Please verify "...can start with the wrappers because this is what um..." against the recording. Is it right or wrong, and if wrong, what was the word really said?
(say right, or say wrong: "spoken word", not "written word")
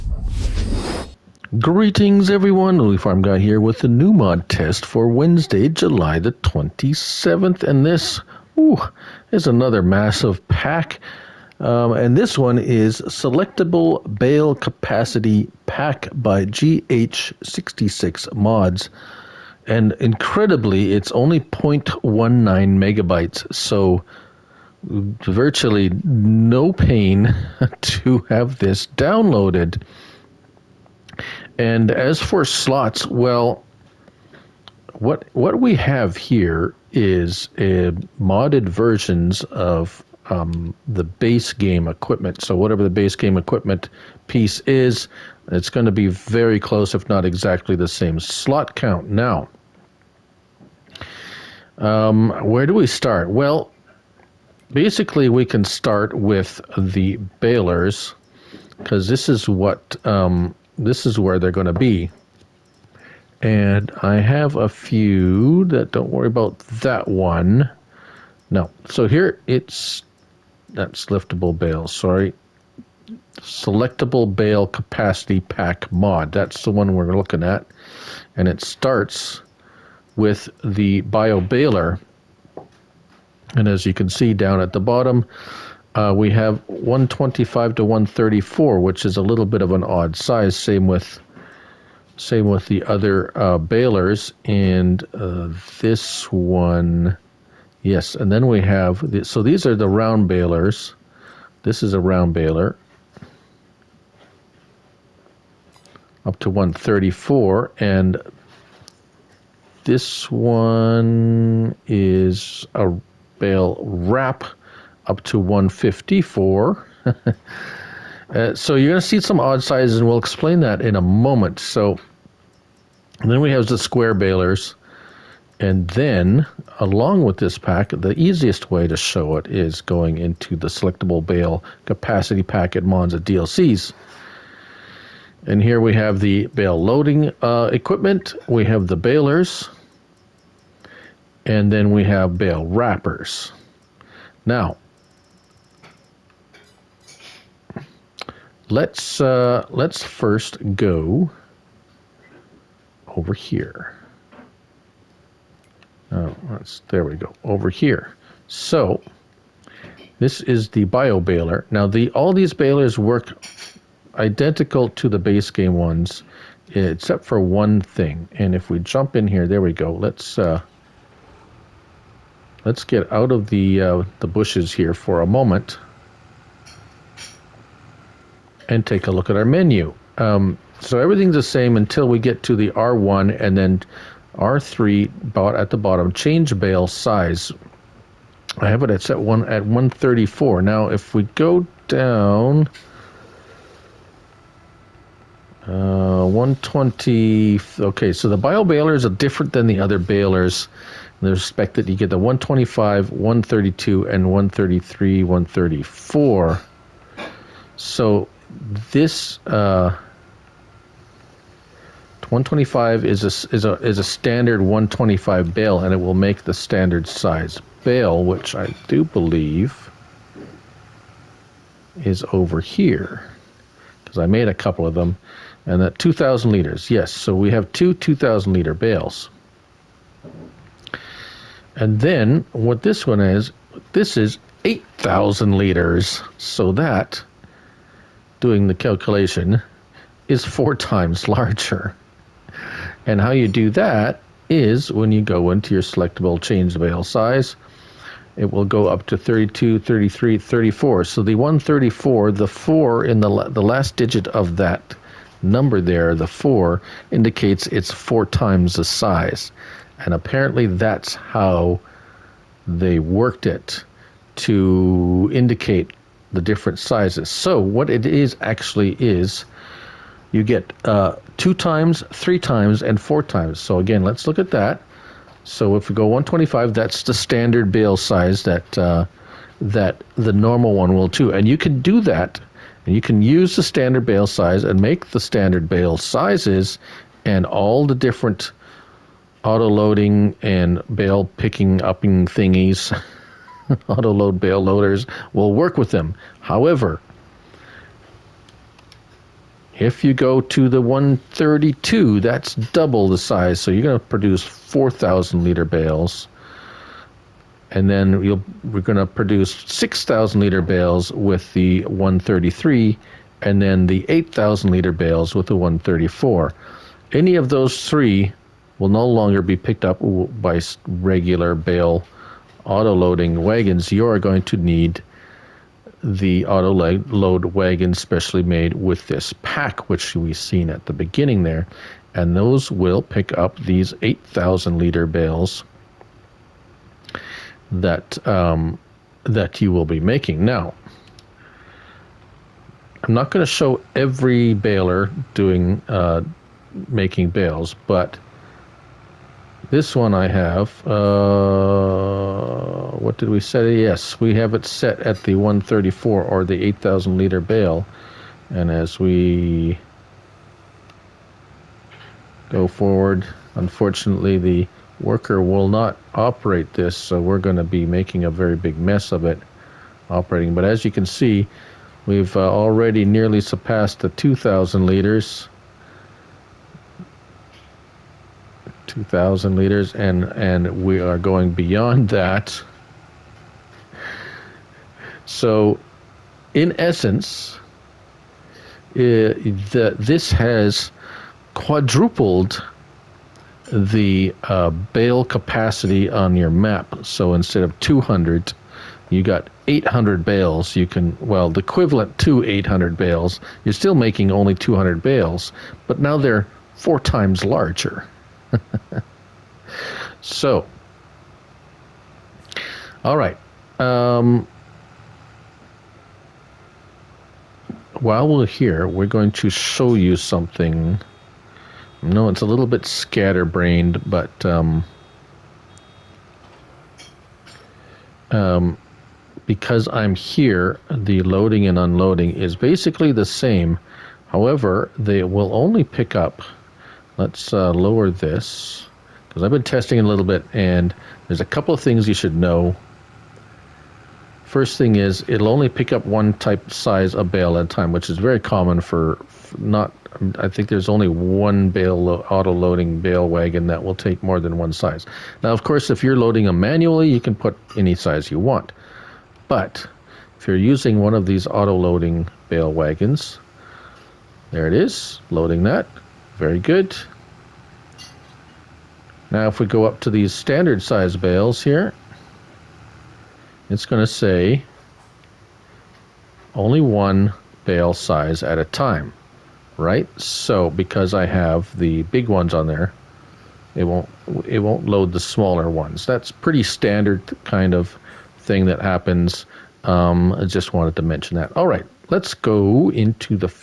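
wrong: "balers", not "wrappers".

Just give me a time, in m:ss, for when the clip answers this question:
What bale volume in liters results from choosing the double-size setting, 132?
5:04.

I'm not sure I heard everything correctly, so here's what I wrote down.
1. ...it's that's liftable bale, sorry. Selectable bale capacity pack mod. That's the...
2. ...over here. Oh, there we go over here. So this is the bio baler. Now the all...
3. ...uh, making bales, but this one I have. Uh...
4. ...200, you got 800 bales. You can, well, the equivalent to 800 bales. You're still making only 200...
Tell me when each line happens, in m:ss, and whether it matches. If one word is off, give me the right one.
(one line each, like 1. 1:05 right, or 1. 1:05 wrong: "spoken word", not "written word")
1. 1:09 right
2. 2:33 right
3. 5:45 right
4. 6:37 right.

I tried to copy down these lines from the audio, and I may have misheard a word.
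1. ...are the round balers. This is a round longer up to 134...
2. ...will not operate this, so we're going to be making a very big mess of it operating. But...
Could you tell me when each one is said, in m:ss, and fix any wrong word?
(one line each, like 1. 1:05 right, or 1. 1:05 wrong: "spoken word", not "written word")
1. 1:39 wrong: "baler", not "longer"
2. 6:05 right.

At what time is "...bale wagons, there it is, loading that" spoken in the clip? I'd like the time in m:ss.
7:42.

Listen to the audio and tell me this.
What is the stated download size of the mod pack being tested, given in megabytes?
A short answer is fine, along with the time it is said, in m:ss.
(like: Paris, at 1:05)
0.19 megabytes, at 0:21.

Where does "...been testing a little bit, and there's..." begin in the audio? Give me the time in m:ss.
7:19.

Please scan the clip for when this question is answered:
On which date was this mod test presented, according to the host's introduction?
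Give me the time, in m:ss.
0:05.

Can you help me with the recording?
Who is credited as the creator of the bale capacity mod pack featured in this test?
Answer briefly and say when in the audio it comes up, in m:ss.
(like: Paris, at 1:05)
GH66 Mods, at 0:16.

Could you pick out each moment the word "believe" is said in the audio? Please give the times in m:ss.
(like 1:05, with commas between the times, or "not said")
3:39.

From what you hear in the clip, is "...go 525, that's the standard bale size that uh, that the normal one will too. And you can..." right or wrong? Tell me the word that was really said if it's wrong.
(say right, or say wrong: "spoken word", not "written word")
wrong: "125", not "525".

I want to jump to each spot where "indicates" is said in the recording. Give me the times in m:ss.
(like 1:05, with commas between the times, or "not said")
4:17, 4:25.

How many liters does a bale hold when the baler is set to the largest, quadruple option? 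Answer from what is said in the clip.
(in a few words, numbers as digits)
8,000 liters.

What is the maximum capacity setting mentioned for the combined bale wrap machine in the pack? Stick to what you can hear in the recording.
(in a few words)
154.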